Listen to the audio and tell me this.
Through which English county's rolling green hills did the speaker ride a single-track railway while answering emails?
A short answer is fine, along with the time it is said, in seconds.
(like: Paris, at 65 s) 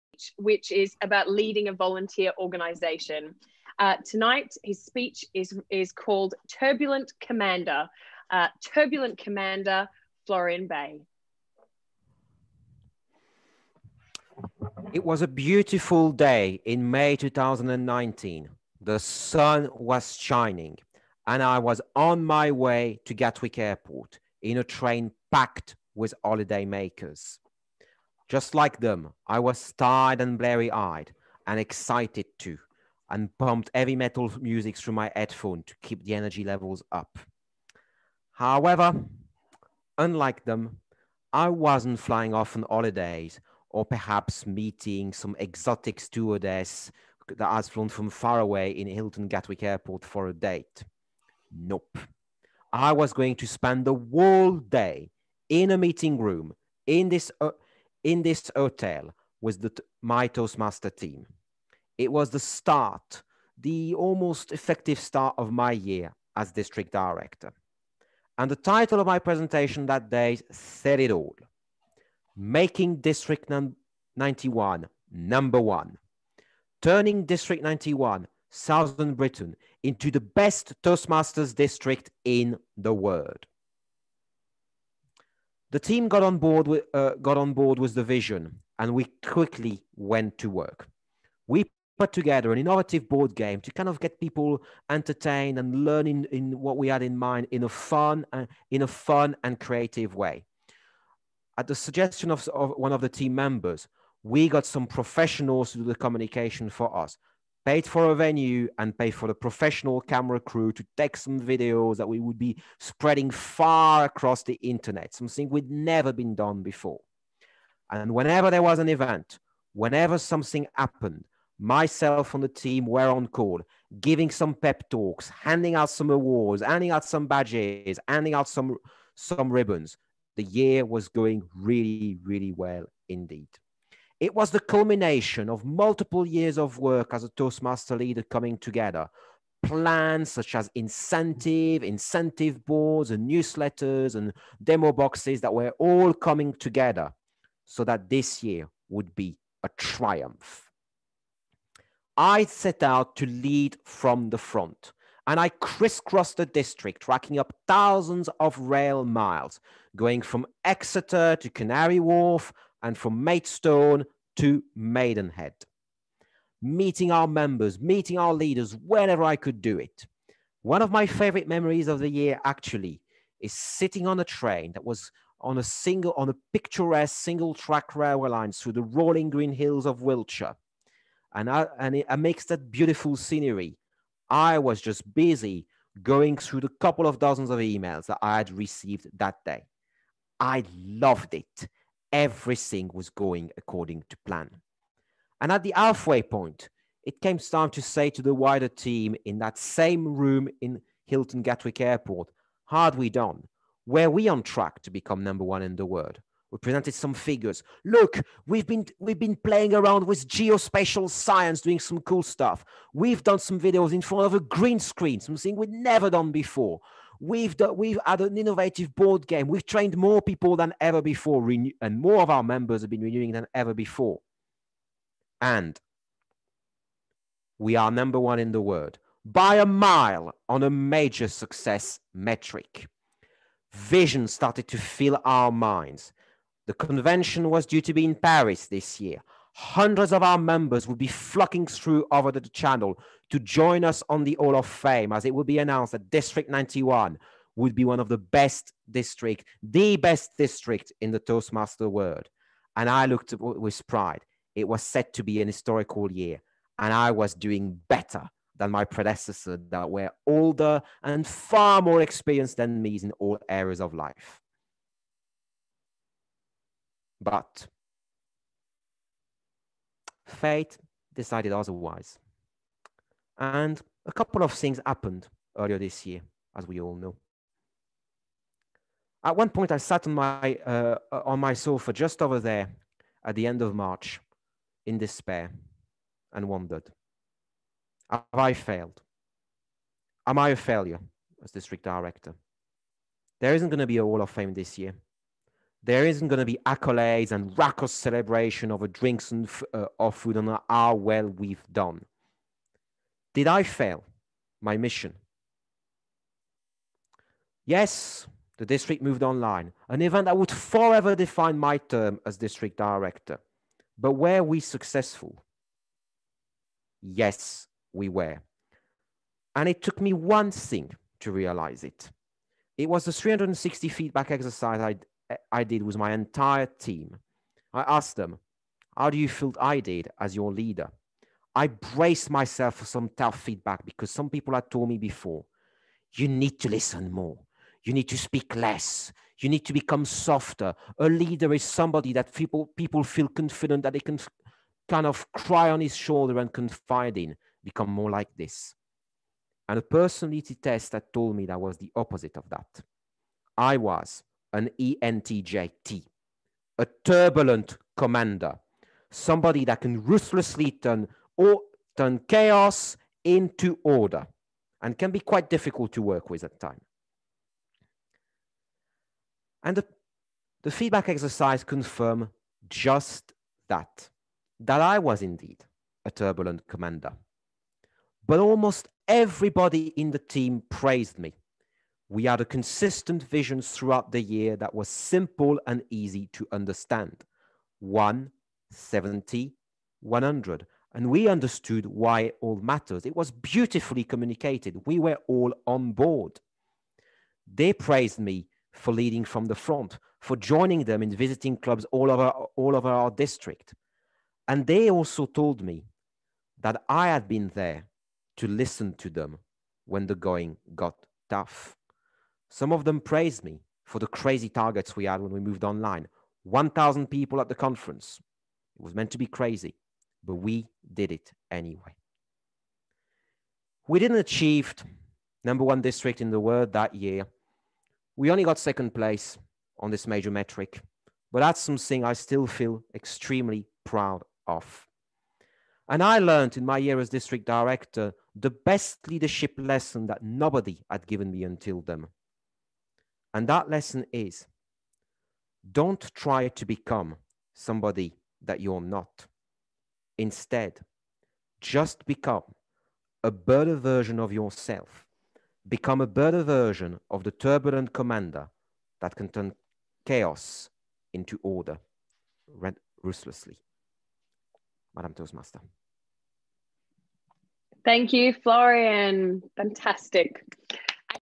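Wiltshire, at 180 s.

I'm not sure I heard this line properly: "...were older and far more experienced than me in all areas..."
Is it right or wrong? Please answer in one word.
right.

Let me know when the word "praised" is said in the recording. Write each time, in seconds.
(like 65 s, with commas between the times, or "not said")
380 s, 397 s, 412 s.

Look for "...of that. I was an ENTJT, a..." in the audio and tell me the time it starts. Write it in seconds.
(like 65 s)
352 s.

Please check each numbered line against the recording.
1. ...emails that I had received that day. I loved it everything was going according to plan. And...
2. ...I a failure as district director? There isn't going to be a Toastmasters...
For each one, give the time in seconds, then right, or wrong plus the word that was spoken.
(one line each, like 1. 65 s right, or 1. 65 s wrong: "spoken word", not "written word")
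1. 187 s right
2. 290 s wrong: "Wall", not "Toastmasters".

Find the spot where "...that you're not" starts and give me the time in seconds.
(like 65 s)
448 s.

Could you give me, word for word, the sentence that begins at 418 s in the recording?
It was meant to be crazy, but we did it anyway.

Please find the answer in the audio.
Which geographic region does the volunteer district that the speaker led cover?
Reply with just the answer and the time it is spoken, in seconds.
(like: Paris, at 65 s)
Southern Britain, at 78 s.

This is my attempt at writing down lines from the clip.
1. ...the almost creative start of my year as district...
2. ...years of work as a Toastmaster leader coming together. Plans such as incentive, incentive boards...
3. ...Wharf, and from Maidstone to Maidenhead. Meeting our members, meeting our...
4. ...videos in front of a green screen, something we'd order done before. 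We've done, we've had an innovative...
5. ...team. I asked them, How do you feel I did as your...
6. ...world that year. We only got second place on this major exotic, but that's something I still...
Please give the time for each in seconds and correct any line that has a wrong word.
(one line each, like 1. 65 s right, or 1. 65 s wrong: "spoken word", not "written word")
1. 63 s wrong: "effective", not "creative"
2. 136 s right
3. 161 s right
4. 213 s wrong: "never", not "order"
5. 326 s right
6. 426 s wrong: "metric", not "exotic".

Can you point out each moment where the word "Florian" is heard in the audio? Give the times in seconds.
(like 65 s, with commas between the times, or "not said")
10 s, 468 s.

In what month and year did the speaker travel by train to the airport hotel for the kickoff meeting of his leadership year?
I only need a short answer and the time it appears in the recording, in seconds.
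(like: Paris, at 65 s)
May 2019, at 16 s.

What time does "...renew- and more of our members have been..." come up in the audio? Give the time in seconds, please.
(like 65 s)
221 s.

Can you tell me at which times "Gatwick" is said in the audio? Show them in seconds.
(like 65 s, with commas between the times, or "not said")
23 s, 49 s, 201 s.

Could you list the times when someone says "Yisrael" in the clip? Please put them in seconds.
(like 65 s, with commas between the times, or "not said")
not said.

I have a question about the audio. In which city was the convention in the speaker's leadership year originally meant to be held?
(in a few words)
Paris.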